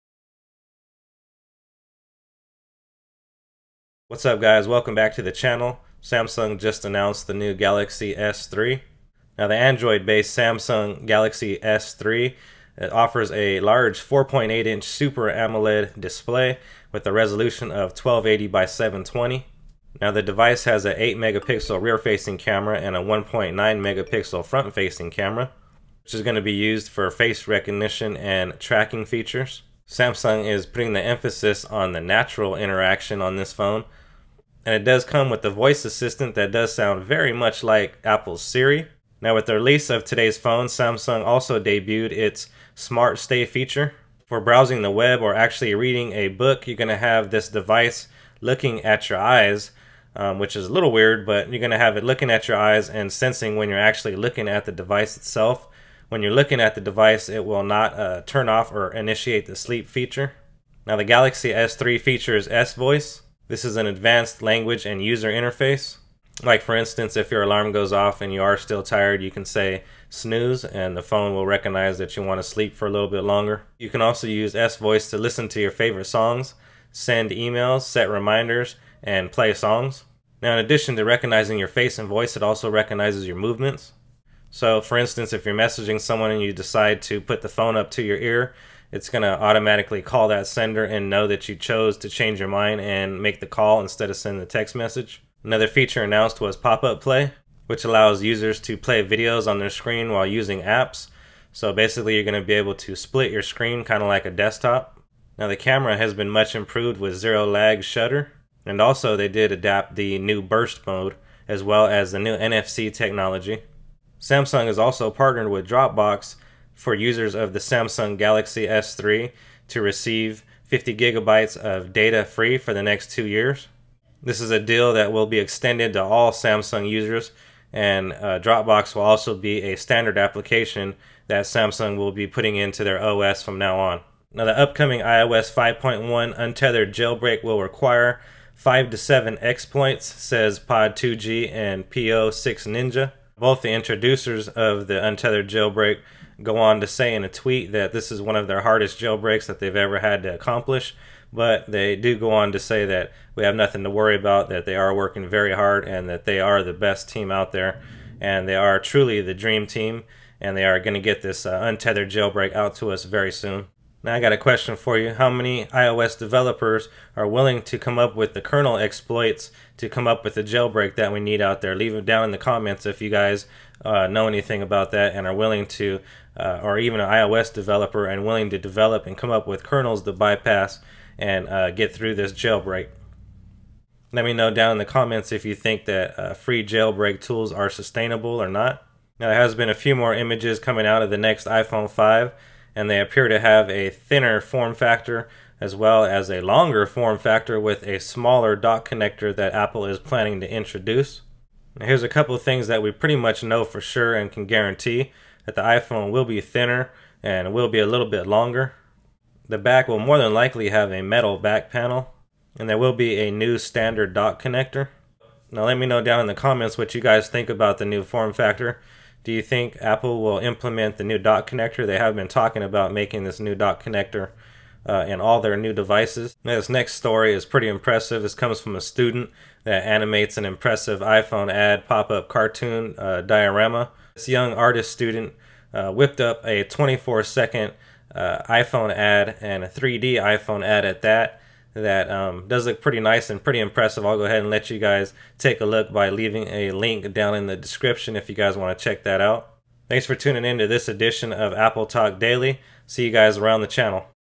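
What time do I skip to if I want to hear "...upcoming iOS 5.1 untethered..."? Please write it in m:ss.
2:14.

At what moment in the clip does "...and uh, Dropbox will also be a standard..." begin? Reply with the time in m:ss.
2:07.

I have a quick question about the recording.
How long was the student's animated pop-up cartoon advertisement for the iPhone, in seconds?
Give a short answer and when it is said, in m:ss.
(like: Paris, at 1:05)
24 seconds, at 3:56.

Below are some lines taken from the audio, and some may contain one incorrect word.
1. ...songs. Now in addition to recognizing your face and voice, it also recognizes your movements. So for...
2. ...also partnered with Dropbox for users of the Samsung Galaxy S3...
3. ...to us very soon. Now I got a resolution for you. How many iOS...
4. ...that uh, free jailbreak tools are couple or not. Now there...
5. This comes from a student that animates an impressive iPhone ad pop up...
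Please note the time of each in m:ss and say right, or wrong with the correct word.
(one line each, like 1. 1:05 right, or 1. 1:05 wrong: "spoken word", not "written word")
1. 1:19 right
2. 1:54 right
3. 2:42 wrong: "question", not "resolution"
4. 3:05 wrong: "sustainable", not "couple"
5. 3:48 right.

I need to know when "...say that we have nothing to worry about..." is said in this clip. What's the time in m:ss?
2:32.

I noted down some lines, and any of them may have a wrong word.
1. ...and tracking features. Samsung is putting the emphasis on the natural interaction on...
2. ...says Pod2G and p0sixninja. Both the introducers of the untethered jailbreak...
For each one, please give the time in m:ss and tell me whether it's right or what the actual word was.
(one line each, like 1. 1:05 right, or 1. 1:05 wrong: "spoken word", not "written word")
1. 0:28 right
2. 2:20 right.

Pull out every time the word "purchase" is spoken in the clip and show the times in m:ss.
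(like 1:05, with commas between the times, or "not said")
not said.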